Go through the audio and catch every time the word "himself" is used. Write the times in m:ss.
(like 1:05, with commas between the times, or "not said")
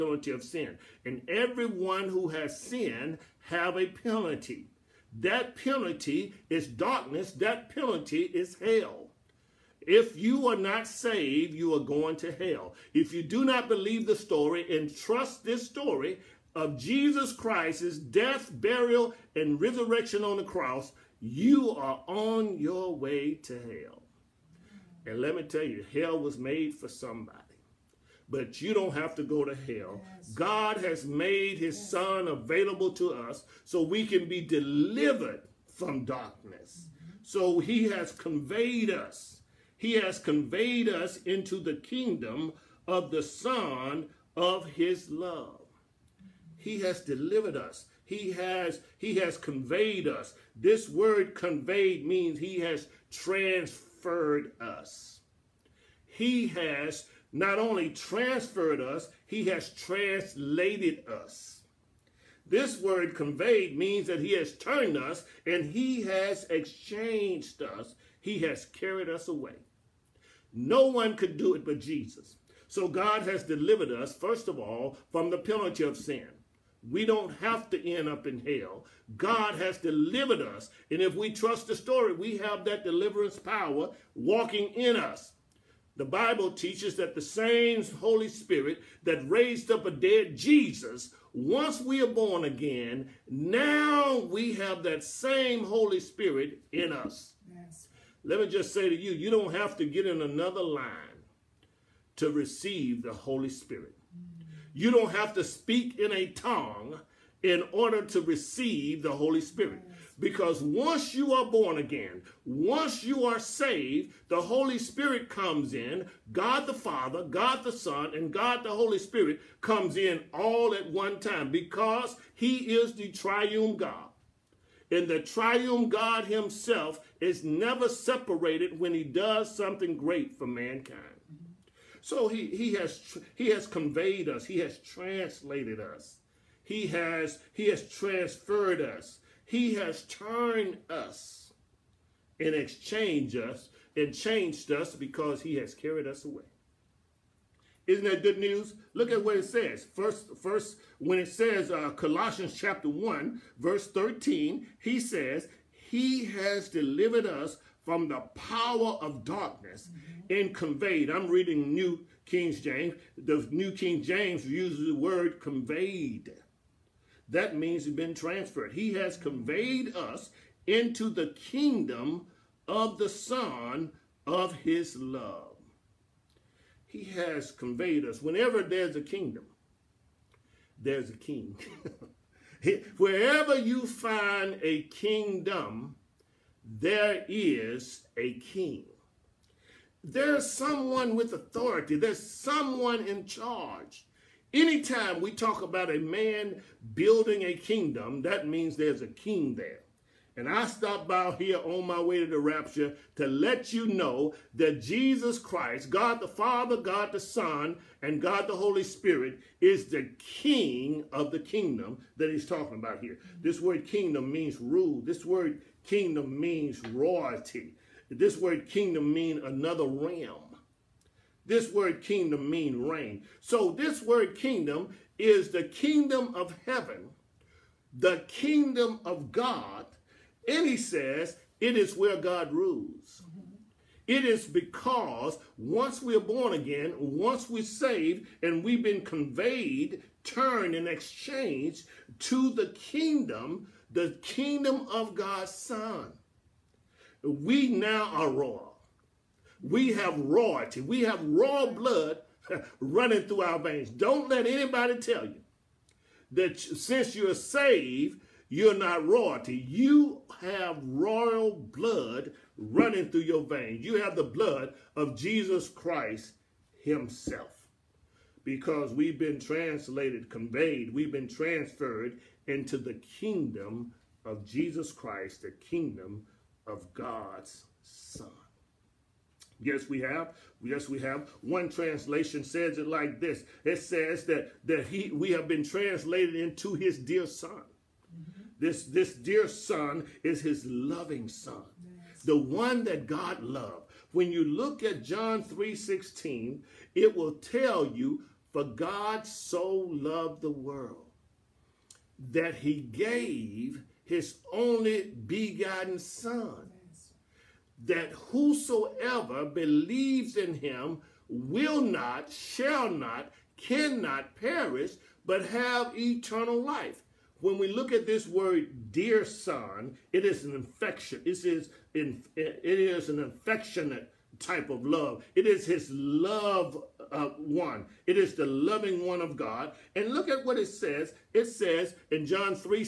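2:06, 4:26.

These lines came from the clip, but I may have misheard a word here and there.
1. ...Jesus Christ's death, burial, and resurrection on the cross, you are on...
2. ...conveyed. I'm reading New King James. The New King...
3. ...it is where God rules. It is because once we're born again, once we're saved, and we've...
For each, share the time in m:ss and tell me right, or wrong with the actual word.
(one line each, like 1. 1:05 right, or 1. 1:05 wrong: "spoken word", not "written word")
1. 0:16 right
2. 2:40 right
3. 3:51 right.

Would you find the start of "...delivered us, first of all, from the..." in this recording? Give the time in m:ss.
1:13.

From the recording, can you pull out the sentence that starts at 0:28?
But you don't have to go to hell.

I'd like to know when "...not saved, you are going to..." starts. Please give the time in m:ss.
0:10.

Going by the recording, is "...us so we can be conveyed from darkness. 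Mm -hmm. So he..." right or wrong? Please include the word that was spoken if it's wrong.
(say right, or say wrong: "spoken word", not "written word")
wrong: "delivered", not "conveyed".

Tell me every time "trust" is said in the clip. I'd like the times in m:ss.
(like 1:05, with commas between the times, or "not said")
0:14, 1:21.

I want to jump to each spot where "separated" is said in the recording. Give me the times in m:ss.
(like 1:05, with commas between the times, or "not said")
2:07.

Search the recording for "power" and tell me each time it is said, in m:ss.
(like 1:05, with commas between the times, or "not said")
1:23, 2:38.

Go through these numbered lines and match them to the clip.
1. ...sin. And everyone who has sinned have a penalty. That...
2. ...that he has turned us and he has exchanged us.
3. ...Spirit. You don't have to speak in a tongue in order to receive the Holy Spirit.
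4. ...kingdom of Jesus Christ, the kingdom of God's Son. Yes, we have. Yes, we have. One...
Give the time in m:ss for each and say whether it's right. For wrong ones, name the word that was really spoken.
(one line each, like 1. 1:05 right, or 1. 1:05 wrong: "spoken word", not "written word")
1. 0:00 right
2. 1:04 right
3. 1:43 right
4. 4:33 right.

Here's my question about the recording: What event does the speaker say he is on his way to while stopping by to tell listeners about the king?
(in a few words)
The rapture.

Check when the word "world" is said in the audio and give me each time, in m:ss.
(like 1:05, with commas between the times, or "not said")
5:00.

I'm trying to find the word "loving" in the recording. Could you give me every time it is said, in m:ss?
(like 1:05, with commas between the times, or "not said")
4:50, 5:28.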